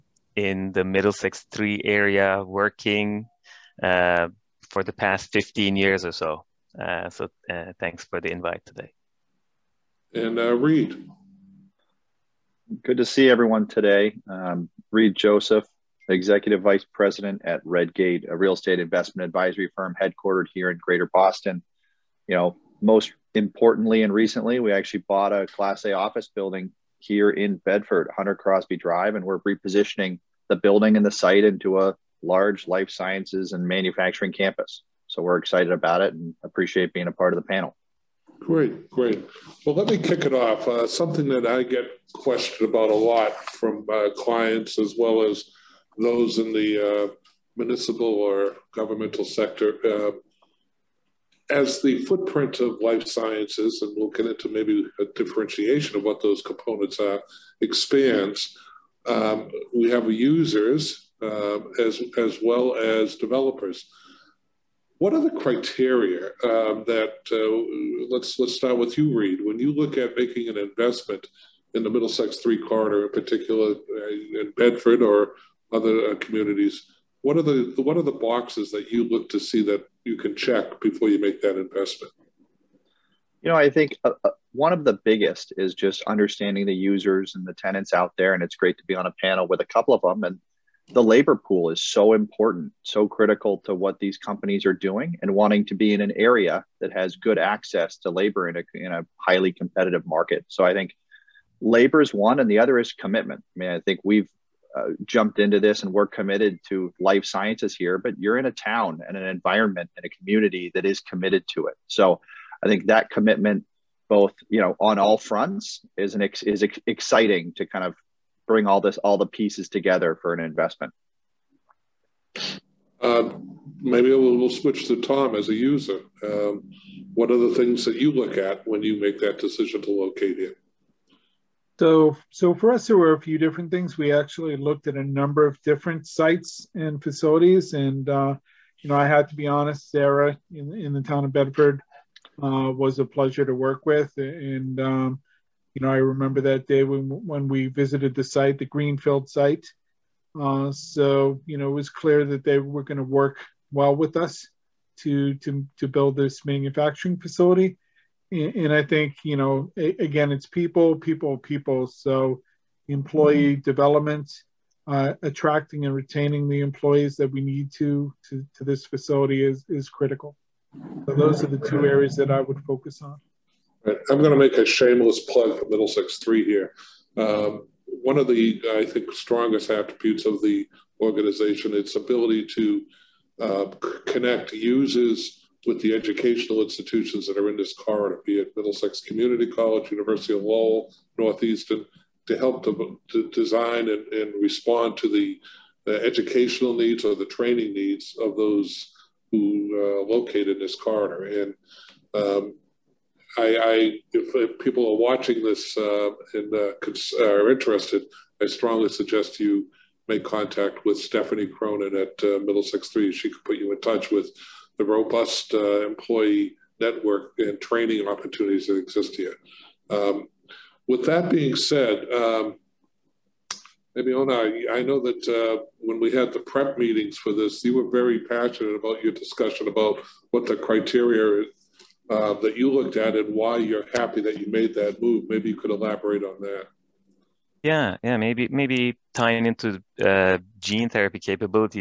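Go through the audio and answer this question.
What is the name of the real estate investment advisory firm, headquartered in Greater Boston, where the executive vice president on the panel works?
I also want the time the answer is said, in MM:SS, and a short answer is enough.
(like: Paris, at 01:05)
Redgate, at 00:17.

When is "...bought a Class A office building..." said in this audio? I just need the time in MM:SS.
00:25.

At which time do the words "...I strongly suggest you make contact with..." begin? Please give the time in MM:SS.
03:28.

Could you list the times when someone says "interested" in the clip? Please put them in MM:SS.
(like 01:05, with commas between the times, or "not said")
03:27.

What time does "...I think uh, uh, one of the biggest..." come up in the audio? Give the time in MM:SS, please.
01:23.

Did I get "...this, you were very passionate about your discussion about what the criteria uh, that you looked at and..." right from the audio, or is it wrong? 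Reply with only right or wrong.
right.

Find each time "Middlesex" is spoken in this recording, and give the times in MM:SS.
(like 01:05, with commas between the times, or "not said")
00:00, 01:11, 02:55, 03:08, 03:32.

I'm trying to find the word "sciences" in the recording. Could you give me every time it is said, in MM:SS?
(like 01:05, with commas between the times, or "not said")
00:32, 00:53, 01:47.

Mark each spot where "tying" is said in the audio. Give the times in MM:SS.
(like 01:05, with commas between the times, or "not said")
03:59.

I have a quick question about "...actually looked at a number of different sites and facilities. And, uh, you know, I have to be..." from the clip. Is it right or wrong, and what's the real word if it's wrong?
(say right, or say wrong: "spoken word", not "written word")
right.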